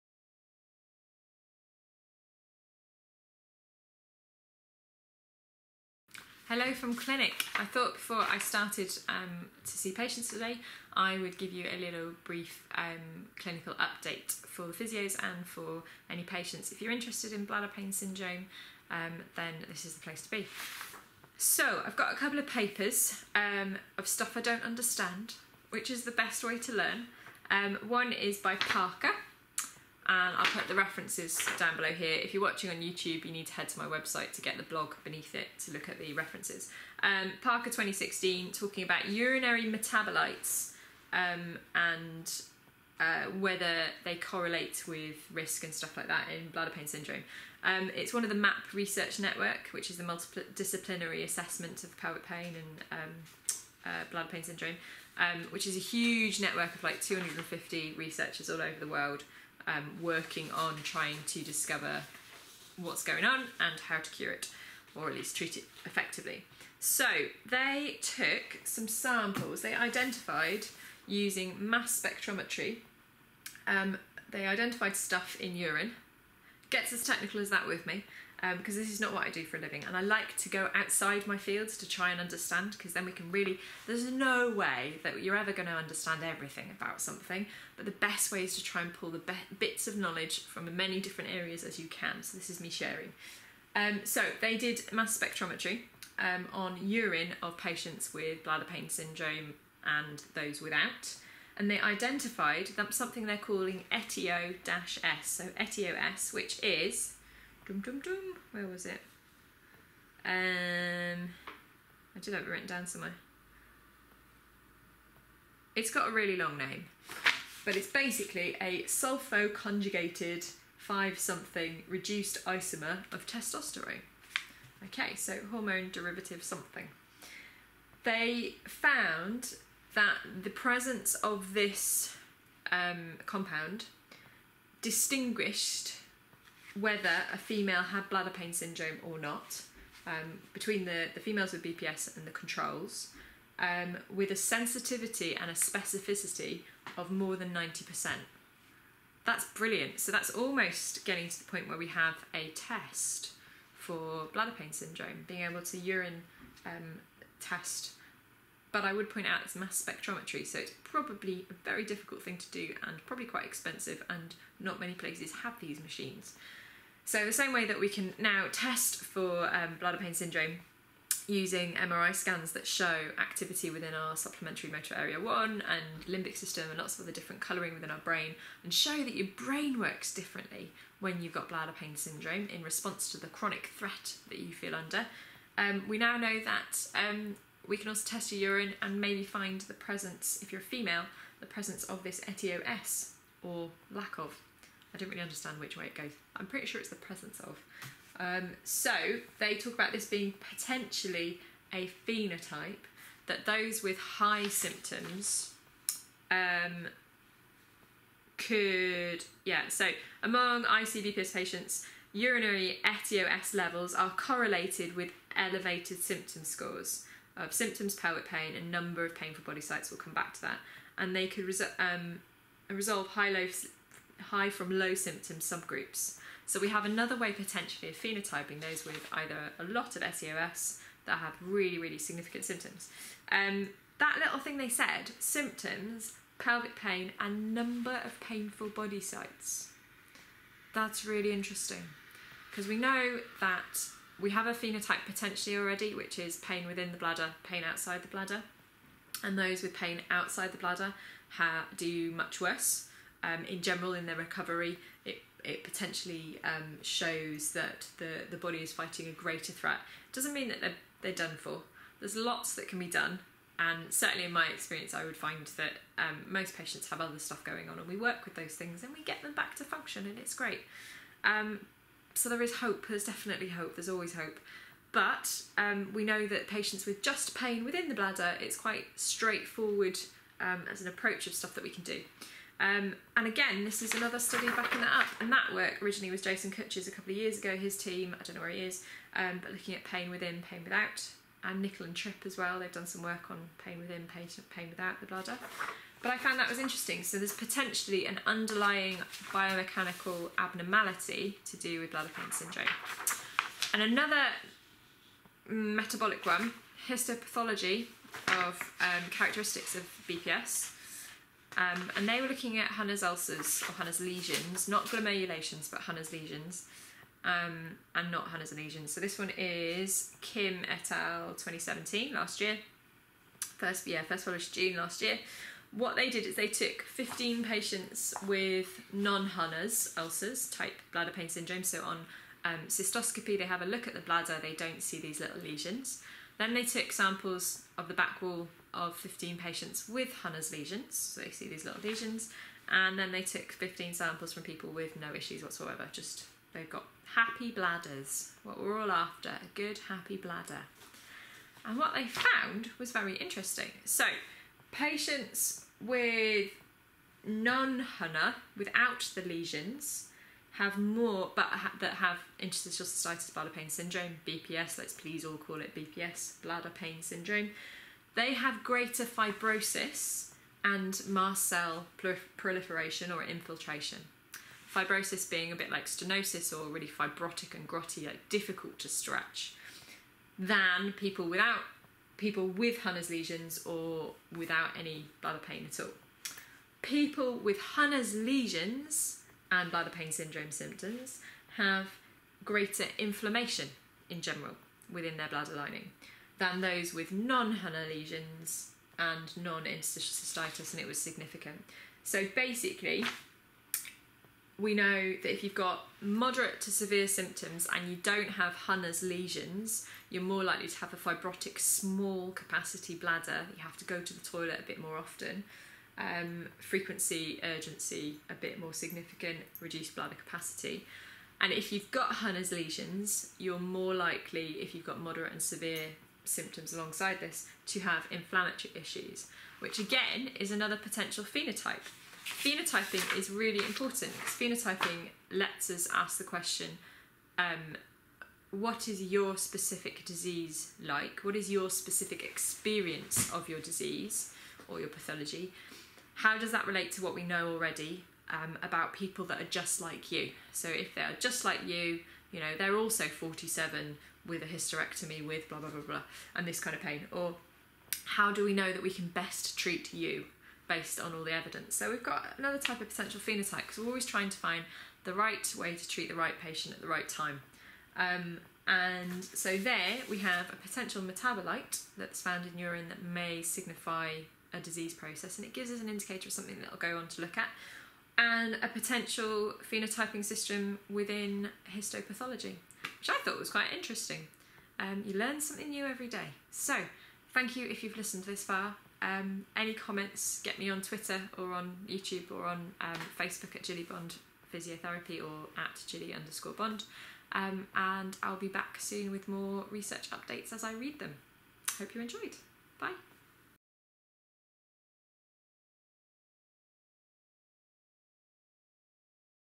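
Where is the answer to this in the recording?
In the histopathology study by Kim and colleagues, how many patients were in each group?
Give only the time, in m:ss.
5:26.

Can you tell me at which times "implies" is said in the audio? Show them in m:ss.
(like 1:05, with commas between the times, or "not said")
not said.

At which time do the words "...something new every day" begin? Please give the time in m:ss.
8:05.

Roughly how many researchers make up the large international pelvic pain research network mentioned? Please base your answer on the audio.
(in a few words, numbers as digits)
250.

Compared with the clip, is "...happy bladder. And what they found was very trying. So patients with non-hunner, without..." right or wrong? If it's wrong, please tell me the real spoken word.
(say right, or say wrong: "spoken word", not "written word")
wrong: "interesting", not "trying".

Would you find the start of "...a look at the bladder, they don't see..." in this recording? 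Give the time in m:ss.
5:33.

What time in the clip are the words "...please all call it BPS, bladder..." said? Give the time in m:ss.
6:04.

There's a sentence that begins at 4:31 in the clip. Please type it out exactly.
Um, so there is hope, there's definitely hope, there's always hope.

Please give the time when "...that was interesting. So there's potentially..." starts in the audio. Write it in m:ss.
4:56.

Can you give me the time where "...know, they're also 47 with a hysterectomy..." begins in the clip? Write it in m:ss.
7:32.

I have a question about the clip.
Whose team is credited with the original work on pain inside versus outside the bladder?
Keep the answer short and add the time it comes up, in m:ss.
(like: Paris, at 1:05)
Jason Kutch, at 4:46.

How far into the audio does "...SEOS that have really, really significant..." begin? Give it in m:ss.
3:50.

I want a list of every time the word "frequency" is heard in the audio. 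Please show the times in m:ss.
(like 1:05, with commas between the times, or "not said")
6:56.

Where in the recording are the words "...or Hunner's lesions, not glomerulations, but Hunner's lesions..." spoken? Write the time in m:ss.
5:13.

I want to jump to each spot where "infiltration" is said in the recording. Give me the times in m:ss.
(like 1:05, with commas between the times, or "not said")
6:13.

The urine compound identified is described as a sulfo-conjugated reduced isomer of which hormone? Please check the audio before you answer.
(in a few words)
testosterone.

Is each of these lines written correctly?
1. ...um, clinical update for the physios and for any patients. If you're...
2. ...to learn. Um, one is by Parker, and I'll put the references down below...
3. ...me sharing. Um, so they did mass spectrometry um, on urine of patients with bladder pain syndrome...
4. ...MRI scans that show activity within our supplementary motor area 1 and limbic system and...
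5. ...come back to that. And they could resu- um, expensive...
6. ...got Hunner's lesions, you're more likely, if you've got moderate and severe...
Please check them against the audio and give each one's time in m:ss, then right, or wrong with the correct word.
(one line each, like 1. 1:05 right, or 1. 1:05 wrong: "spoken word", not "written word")
1. 0:12 right
2. 0:26 right
3. 1:32 right
4. 2:51 right
5. 3:39 wrong: "resolve", not "expensive"
6. 7:01 right.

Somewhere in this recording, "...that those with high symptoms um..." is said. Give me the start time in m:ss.
3:23.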